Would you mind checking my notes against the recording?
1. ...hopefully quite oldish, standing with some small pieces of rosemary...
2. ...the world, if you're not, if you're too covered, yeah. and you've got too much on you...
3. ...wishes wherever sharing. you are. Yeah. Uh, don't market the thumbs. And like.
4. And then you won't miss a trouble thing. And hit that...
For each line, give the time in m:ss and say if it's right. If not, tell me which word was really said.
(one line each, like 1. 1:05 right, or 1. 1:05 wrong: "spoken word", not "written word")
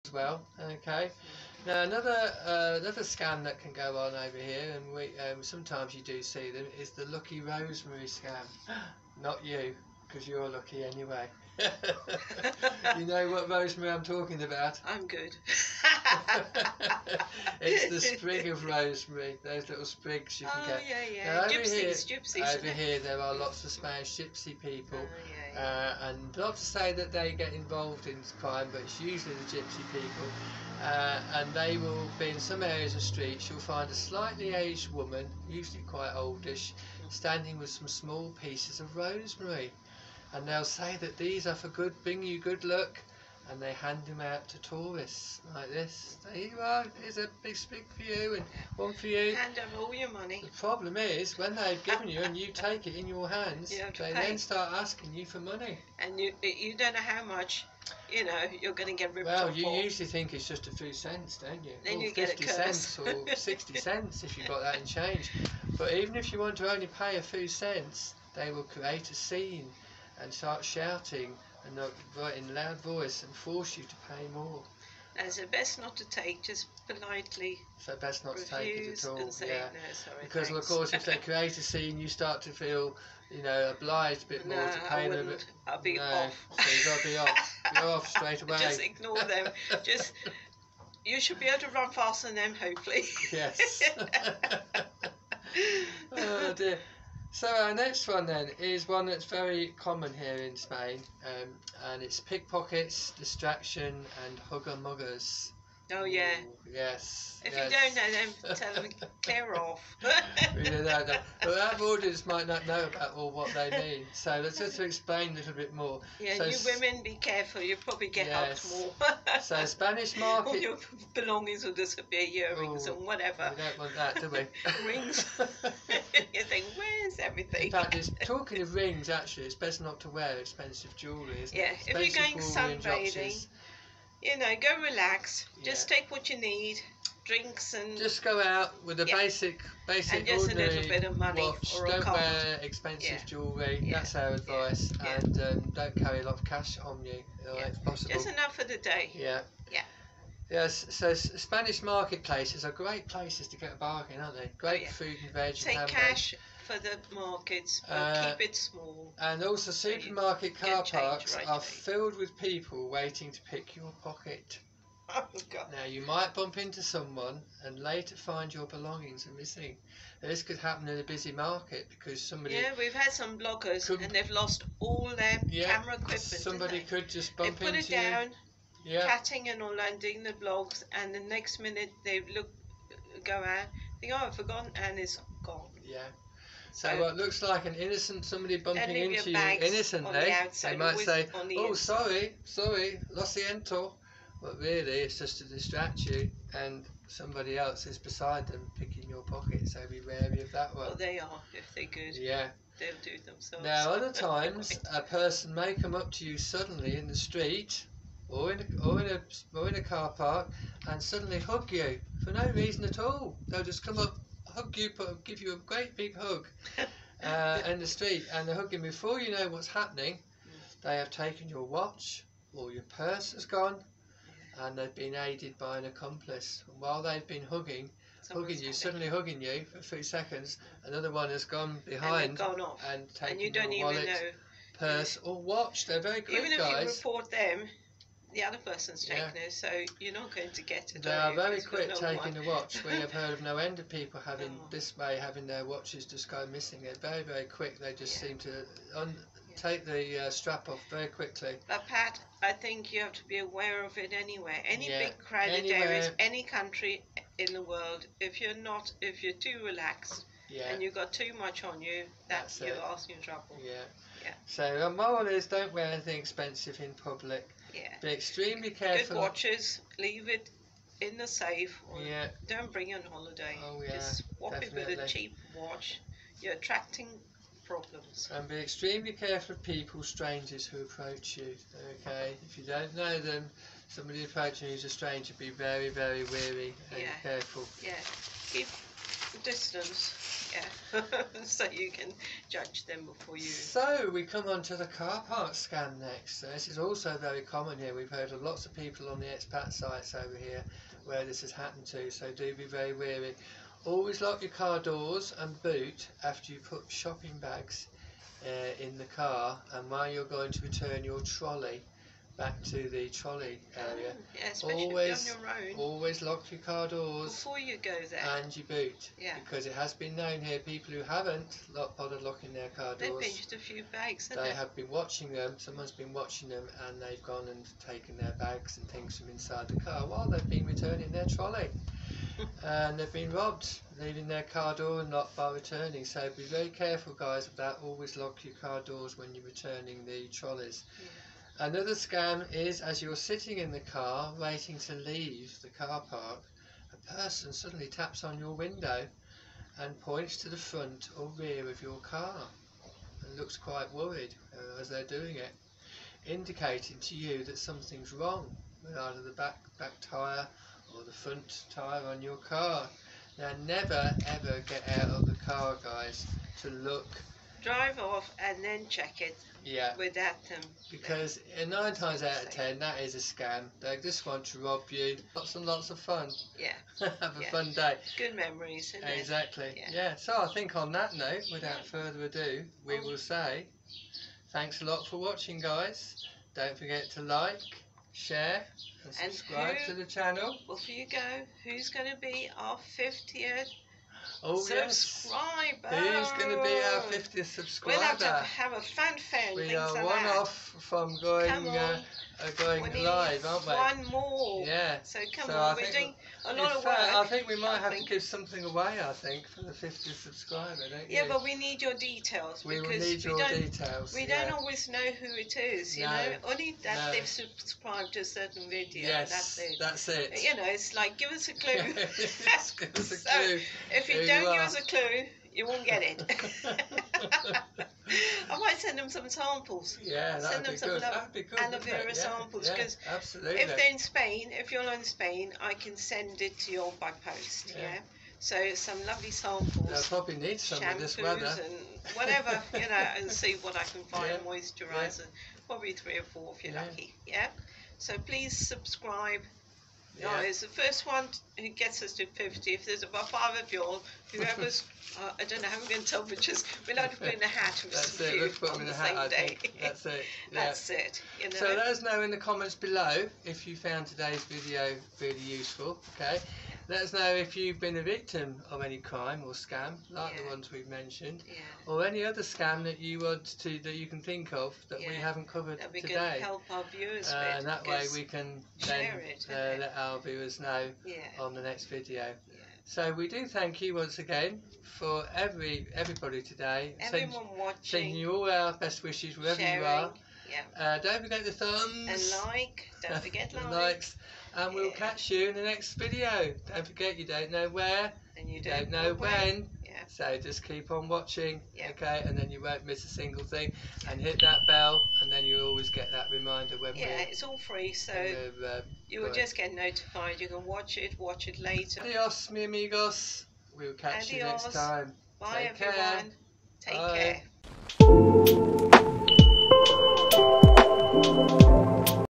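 1. 0:35 wrong: "usually", not "hopefully"
2. 4:17 wrong: "relaxed", not "covered"
3. 8:09 wrong: "forget", not "market"
4. 8:22 wrong: "single", not "trouble".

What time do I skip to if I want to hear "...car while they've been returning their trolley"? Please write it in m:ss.
5:29.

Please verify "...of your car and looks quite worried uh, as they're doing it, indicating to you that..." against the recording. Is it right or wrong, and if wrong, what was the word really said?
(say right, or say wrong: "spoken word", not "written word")
right.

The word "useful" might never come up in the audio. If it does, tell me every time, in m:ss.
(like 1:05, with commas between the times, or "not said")
7:45.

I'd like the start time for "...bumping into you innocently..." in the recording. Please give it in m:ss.
3:08.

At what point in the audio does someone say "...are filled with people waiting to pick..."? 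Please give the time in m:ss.
2:41.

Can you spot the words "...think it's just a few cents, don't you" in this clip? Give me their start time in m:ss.
1:00.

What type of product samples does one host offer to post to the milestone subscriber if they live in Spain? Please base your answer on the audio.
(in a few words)
Aloe vera.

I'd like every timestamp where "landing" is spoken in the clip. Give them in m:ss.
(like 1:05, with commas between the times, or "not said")
2:59.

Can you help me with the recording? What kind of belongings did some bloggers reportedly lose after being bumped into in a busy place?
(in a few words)
Camera equipment.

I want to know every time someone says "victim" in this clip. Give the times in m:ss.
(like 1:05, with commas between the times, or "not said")
7:48.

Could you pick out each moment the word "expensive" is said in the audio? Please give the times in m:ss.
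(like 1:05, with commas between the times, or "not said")
2:10, 2:22, 4:26.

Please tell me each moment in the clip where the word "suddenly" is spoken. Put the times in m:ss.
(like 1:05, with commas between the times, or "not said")
3:26, 3:31, 3:48, 5:47.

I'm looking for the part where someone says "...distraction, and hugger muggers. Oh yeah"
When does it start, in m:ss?
1:43.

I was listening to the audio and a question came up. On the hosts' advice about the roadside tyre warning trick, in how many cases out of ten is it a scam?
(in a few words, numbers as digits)
9.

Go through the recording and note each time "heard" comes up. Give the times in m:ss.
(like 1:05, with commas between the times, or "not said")
4:03, 4:58.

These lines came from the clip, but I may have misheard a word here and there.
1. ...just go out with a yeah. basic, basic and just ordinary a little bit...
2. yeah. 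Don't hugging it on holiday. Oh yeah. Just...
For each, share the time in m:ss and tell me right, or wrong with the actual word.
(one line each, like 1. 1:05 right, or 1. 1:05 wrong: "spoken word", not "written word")
1. 2:17 right
2. 4:32 wrong: "bring", not "hugging".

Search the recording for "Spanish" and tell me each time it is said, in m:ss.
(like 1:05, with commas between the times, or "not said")
0:23, 1:59, 2:31.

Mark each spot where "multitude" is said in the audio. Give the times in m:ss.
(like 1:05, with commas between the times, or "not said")
not said.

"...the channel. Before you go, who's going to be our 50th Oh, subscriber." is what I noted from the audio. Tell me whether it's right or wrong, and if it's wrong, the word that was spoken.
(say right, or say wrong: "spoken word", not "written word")
right.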